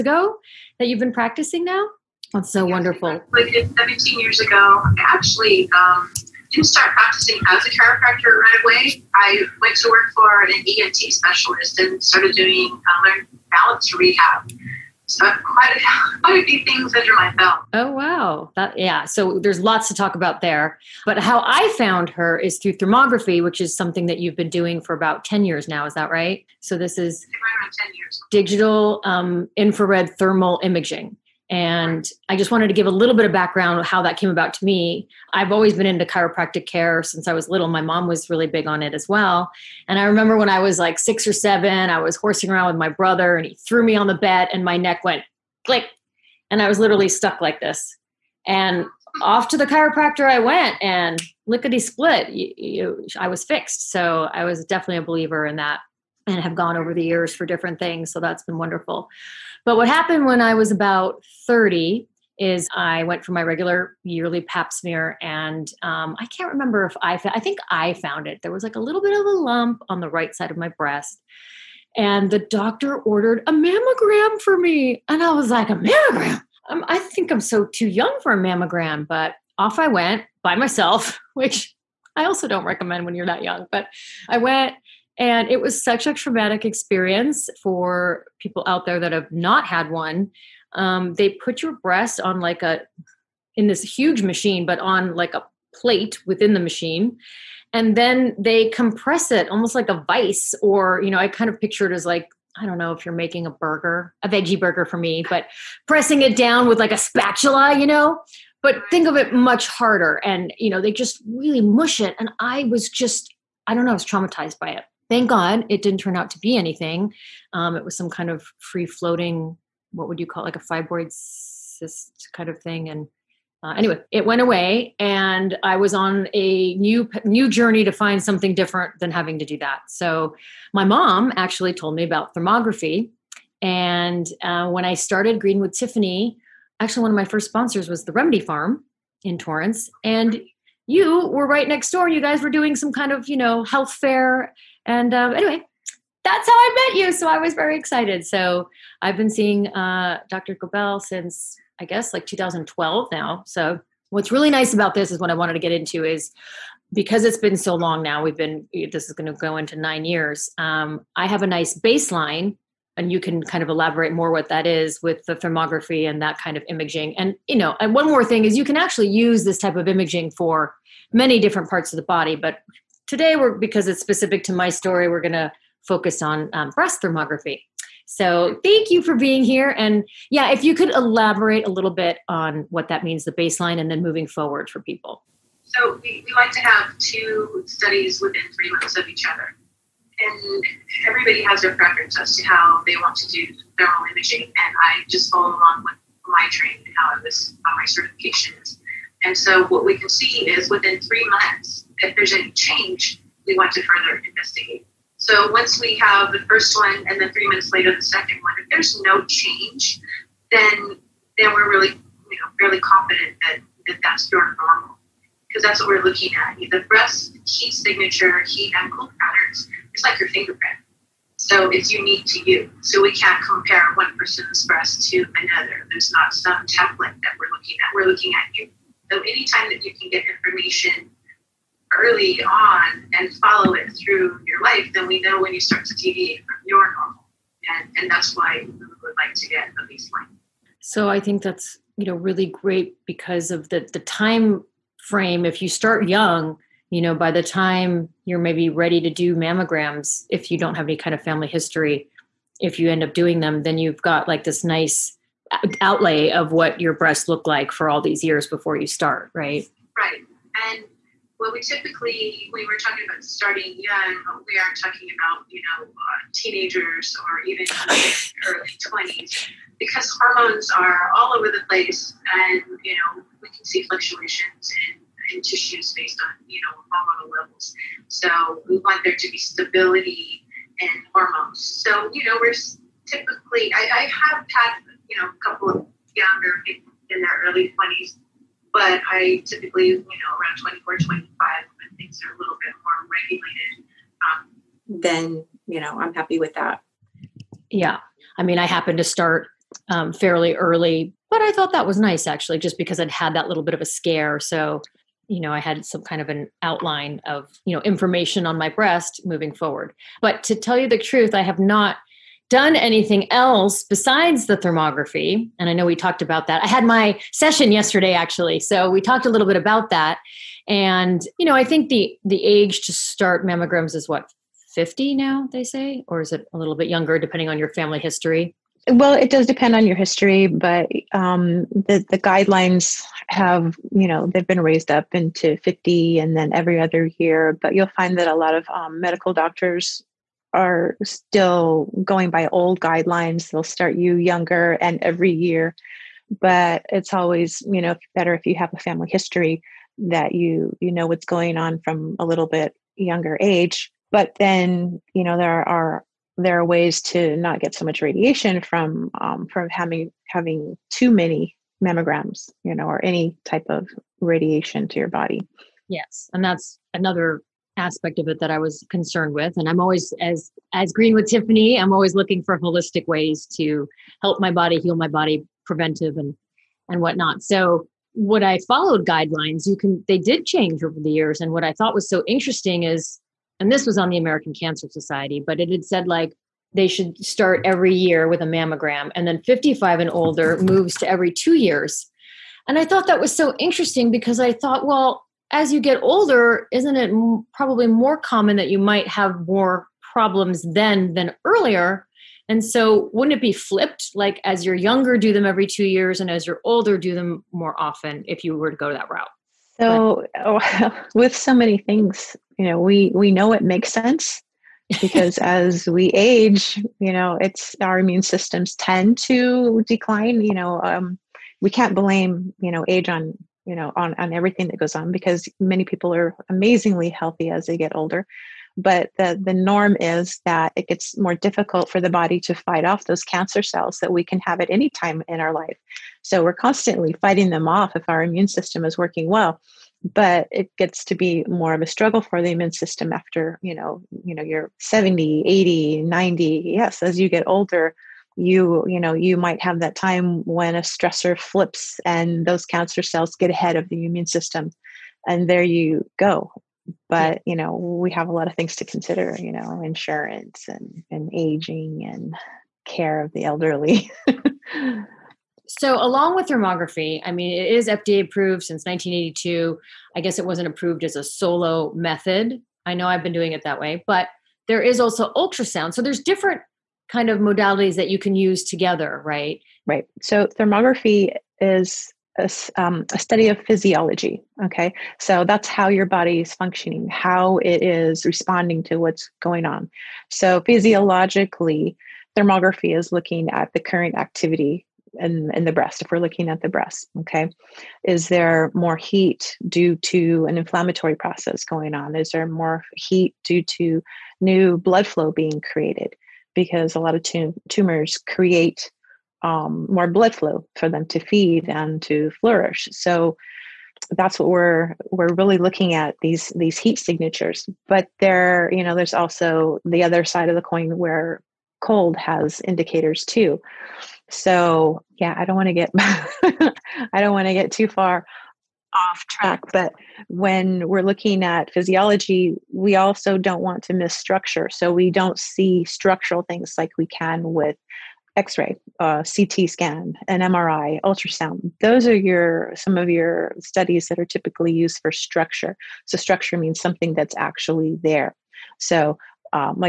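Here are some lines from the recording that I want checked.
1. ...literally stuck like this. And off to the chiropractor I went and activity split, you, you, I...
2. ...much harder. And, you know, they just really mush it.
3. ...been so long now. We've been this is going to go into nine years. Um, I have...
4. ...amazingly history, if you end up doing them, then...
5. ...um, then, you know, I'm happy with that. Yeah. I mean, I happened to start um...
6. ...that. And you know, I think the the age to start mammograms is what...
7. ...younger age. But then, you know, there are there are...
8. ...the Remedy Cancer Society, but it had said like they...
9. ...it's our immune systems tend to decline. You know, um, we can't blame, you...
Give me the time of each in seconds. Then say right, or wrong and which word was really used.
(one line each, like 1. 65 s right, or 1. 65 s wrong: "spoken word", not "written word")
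1. 46 s wrong: "lickety", not "activity"
2. 109 s right
3. 157 s right
4. 251 s wrong: "family", not "amazingly"
5. 294 s right
6. 319 s right
7. 352 s right
8. 384 s wrong: "American", not "Remedy"
9. 417 s right.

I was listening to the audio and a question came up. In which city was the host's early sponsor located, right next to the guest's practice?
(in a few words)
Torrance.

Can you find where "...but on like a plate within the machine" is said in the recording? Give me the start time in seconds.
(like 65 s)
94 s.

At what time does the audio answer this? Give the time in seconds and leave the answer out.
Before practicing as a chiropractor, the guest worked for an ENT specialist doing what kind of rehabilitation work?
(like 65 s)
13 s.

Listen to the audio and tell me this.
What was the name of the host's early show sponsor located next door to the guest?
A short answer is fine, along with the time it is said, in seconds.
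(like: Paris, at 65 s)
Remedy Farm, at 138 s.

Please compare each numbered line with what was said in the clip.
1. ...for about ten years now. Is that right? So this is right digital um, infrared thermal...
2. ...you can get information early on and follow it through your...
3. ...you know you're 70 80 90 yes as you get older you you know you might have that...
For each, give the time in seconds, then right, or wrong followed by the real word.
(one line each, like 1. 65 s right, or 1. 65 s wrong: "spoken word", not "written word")
1. 24 s right
2. 229 s right
3. 444 s right.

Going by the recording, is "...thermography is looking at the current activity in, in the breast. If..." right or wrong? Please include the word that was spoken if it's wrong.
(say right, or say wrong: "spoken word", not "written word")
right.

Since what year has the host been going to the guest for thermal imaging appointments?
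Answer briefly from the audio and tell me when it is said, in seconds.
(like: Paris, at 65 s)
2012, at 152 s.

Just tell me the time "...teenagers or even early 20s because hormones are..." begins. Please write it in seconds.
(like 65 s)
266 s.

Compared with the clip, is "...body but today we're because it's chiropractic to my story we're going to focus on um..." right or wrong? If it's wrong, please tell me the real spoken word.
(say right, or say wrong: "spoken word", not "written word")
wrong: "specific", not "chiropractic".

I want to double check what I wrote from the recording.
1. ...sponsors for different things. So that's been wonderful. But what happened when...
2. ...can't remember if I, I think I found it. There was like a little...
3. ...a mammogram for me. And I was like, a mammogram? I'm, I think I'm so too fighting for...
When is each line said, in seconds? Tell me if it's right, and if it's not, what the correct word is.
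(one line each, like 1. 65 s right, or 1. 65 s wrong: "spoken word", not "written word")
1. 57 s wrong: "years", not "sponsors"
2. 66 s right
3. 73 s wrong: "young", not "fighting".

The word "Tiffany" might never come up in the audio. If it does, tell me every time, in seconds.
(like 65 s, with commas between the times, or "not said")
135 s, 371 s.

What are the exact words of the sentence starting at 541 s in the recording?
Those are your some of your studies that are typically used for structure.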